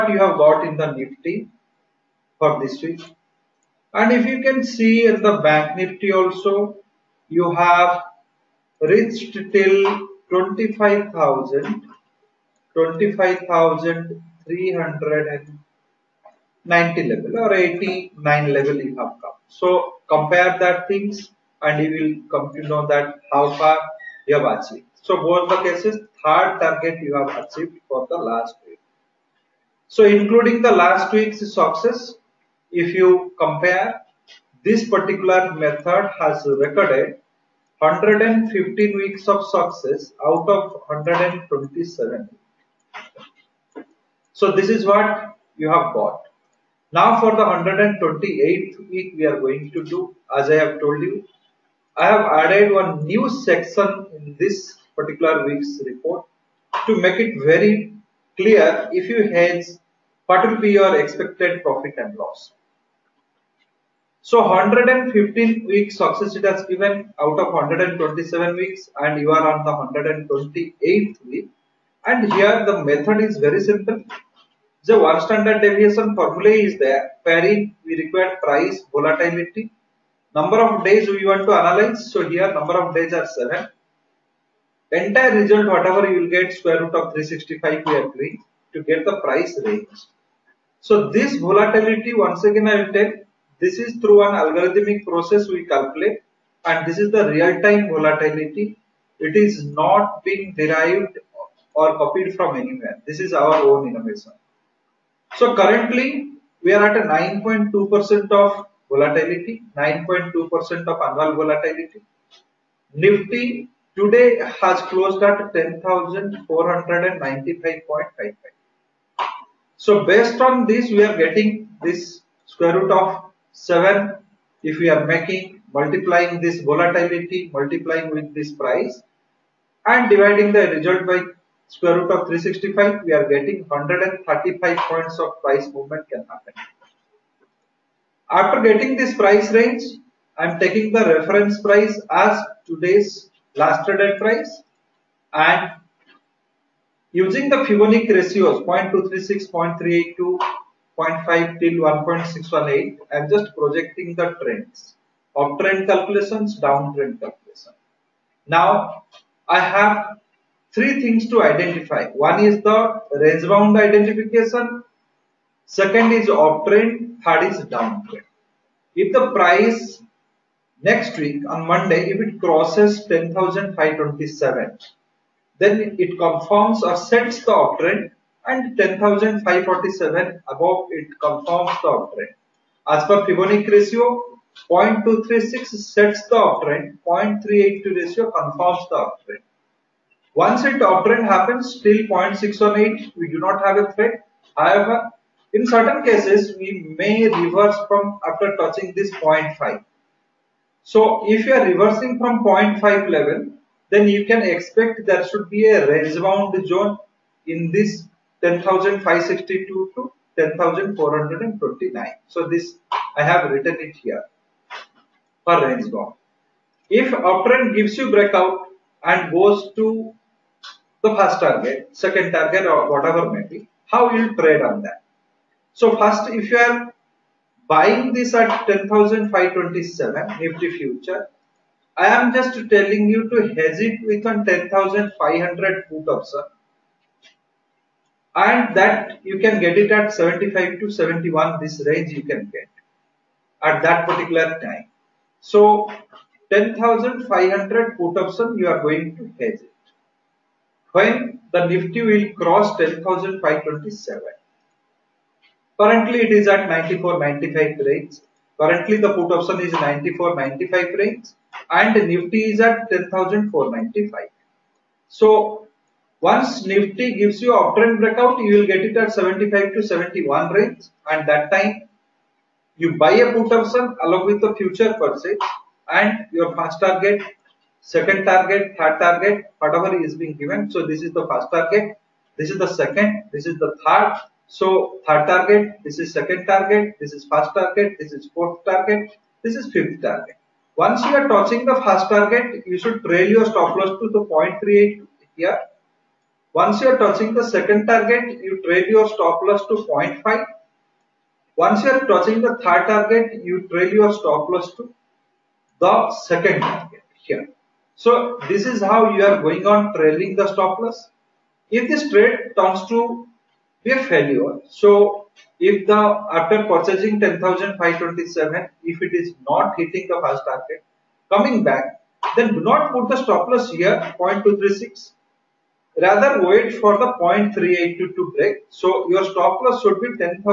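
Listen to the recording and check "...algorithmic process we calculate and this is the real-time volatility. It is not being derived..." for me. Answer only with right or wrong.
right.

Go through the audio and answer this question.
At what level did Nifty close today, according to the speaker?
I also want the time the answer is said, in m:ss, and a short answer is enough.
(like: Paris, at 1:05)
10,495.55, at 1:55.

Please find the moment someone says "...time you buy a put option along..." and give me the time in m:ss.
4:31.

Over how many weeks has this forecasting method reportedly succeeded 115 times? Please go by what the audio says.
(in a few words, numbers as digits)
127.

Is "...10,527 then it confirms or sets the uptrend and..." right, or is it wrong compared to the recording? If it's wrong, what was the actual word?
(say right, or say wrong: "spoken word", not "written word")
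right.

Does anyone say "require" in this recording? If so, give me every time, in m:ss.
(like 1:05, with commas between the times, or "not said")
1:17.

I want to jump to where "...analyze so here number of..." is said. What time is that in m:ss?
1:21.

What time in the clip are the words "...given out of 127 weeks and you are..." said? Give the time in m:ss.
1:06.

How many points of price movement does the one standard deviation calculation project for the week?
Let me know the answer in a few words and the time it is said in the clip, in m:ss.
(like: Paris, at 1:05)
135, at 2:13.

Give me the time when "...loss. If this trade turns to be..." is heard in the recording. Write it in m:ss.
5:10.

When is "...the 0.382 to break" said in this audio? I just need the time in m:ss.
5:26.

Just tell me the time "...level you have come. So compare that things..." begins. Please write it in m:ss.
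0:18.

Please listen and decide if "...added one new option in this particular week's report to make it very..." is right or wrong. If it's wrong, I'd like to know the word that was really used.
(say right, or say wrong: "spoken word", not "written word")
wrong: "section", not "option".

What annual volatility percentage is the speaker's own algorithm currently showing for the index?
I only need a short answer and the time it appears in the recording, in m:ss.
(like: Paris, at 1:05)
9.2%, at 1:47.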